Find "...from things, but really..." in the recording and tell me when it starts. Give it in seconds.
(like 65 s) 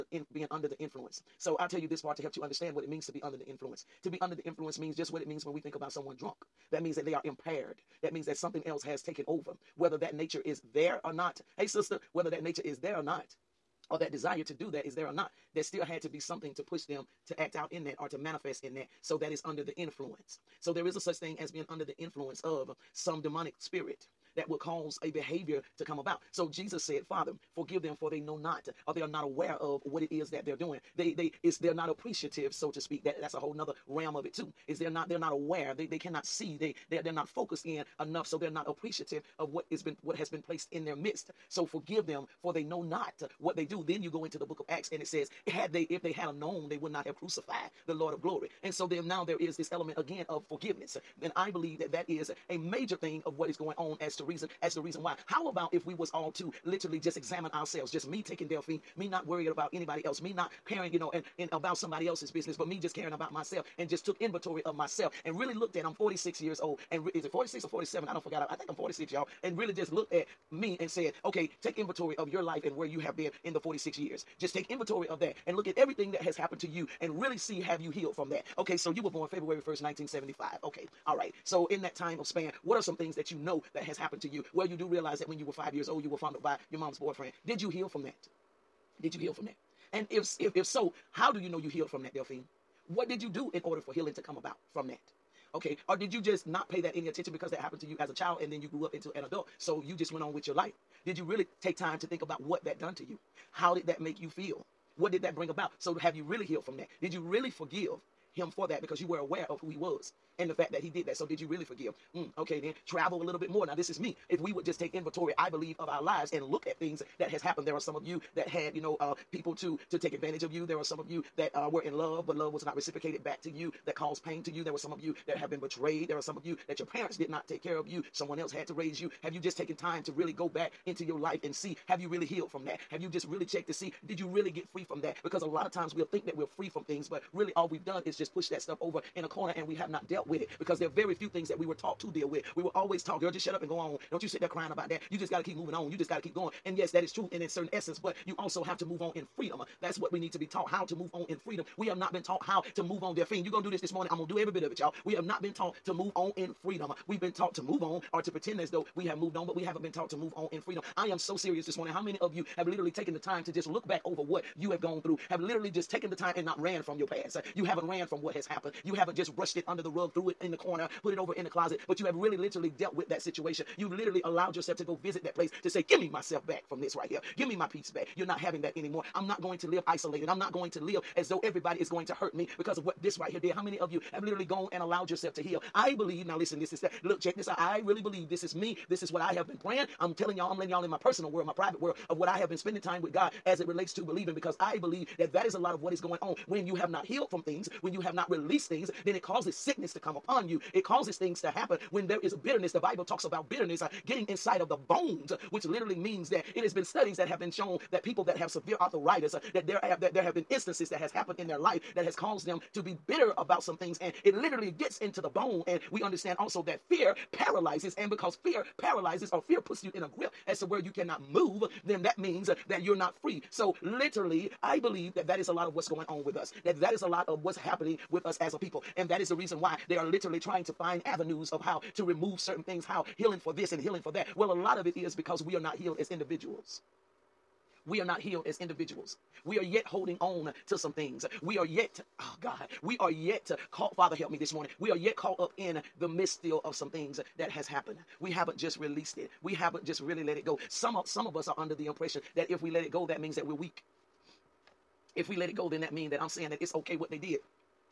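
136 s.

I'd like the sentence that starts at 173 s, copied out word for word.
You've literally allowed yourself to go visit that place to say, Give me myself back from this right here.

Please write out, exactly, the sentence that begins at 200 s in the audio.
It causes things to happen when there is bitterness.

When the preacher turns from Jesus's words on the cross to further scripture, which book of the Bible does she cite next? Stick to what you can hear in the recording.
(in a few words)
Acts.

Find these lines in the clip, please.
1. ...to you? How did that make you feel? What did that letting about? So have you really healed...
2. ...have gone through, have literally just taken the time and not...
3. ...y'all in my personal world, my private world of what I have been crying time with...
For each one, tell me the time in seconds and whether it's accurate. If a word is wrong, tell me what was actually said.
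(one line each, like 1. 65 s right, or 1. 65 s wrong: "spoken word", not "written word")
1. 102 s wrong: "bring", not "letting"
2. 164 s right
3. 190 s wrong: "spending", not "crying".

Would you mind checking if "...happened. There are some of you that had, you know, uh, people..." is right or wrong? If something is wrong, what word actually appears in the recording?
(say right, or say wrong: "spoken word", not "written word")
right.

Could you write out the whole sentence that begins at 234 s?
Well, a lot of it is because we are not healed as individuals.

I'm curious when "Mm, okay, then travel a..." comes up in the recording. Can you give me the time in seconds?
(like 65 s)
112 s.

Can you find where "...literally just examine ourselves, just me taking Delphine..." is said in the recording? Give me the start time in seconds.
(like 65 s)
56 s.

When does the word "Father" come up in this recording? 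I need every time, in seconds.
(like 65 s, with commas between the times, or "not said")
27 s, 243 s.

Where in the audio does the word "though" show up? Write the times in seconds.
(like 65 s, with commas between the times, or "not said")
158 s, 181 s.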